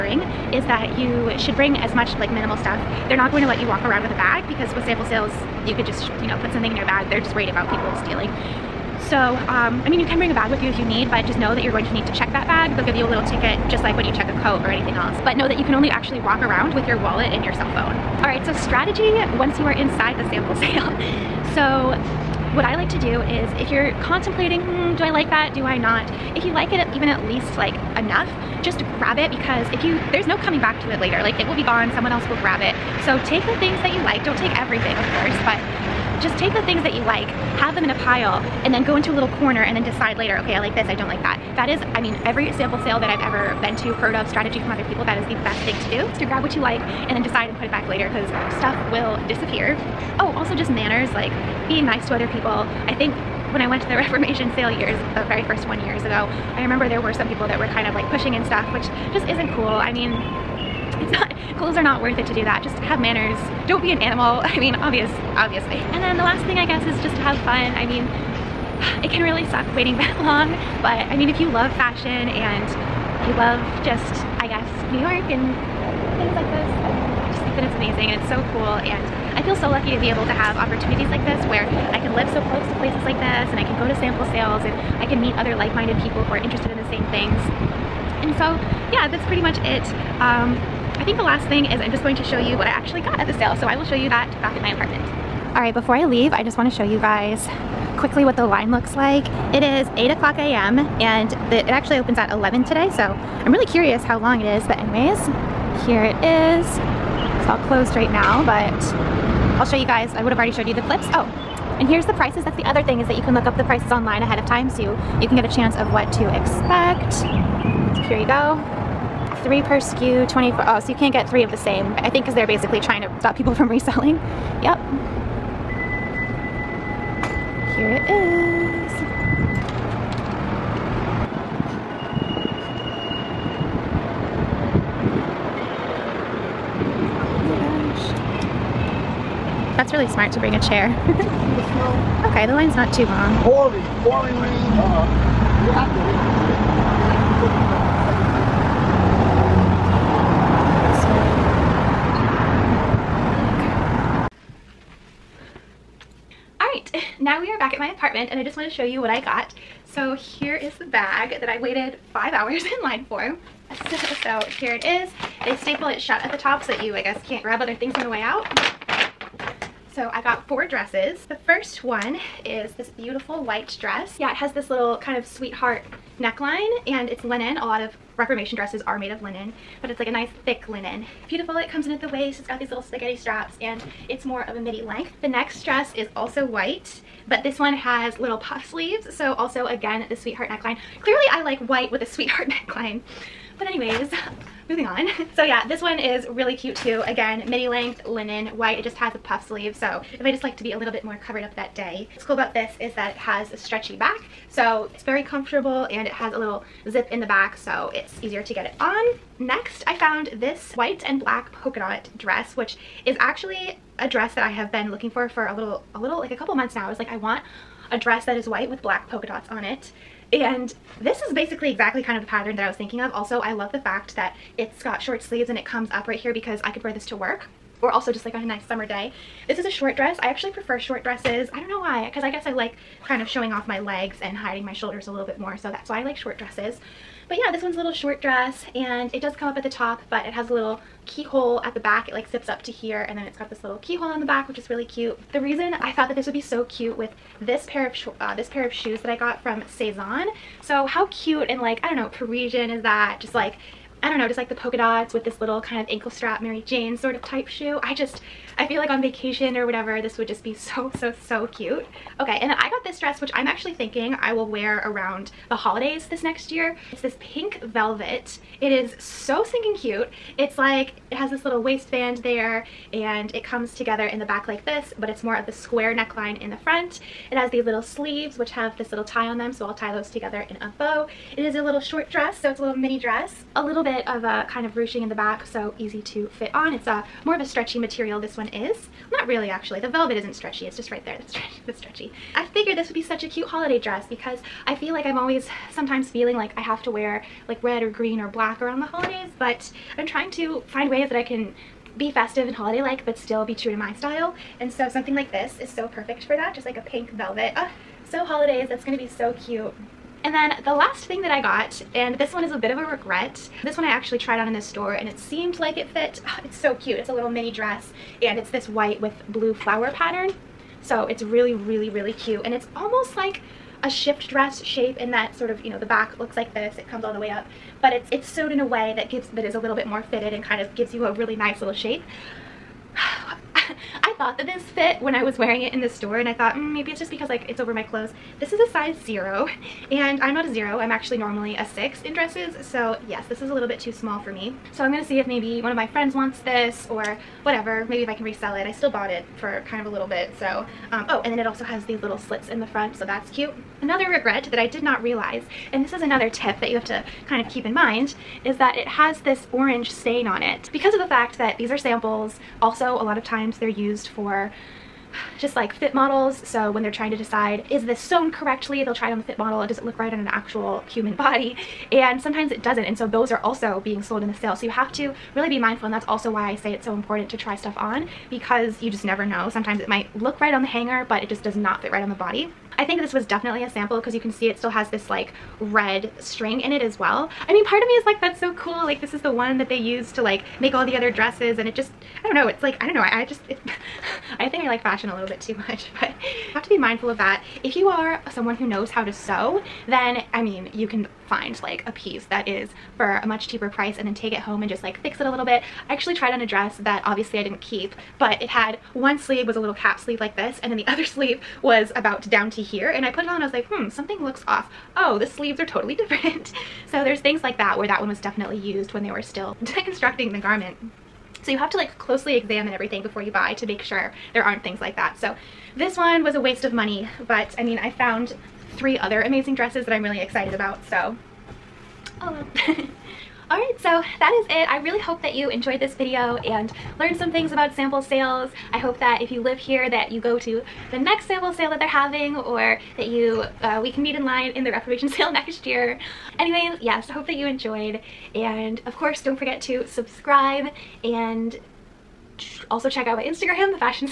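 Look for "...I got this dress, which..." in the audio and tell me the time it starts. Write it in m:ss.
4:22.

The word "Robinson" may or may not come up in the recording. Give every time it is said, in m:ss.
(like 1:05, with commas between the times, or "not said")
not said.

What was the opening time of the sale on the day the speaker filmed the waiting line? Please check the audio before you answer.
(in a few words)
11.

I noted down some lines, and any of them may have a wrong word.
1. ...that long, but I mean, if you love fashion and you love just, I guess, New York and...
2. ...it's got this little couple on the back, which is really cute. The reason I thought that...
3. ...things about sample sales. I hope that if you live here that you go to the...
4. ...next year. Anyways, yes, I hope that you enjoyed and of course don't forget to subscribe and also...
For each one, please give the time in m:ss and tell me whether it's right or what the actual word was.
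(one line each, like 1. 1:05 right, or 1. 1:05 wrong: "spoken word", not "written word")
1. 1:09 right
2. 4:03 wrong: "keyhole", not "couple"
3. 7:17 right
4. 7:25 right.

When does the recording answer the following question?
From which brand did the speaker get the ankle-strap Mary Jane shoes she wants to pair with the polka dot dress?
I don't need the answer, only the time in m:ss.
4:09.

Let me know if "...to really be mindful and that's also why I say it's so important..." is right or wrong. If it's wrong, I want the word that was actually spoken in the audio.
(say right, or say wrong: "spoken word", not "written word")
right.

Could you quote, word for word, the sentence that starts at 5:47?
Maybe if I can resell it.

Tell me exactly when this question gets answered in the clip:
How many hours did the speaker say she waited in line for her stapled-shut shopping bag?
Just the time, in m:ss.
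2:42.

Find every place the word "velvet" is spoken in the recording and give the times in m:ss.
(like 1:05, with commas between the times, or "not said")
4:27, 4:49, 5:07.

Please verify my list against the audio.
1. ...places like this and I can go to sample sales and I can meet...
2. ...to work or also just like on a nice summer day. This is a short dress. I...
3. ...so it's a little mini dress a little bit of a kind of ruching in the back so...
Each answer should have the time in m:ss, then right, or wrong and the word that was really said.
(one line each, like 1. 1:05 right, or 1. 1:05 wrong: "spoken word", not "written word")
1. 1:22 right
2. 3:47 right
3. 4:42 right.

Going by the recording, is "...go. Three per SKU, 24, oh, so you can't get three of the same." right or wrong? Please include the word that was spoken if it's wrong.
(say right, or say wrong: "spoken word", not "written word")
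right.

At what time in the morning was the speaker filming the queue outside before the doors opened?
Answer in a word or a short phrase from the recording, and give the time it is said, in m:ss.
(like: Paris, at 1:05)
8 a.m., at 1:39.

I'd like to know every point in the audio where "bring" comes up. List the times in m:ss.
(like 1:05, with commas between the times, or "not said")
0:01, 0:10, 2:20.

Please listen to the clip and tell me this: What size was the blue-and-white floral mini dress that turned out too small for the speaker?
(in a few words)
0.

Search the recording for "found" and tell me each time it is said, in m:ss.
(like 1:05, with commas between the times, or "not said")
3:29, 7:07.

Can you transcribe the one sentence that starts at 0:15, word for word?
But know that you can only actually walk around with your wallet and your cell phone.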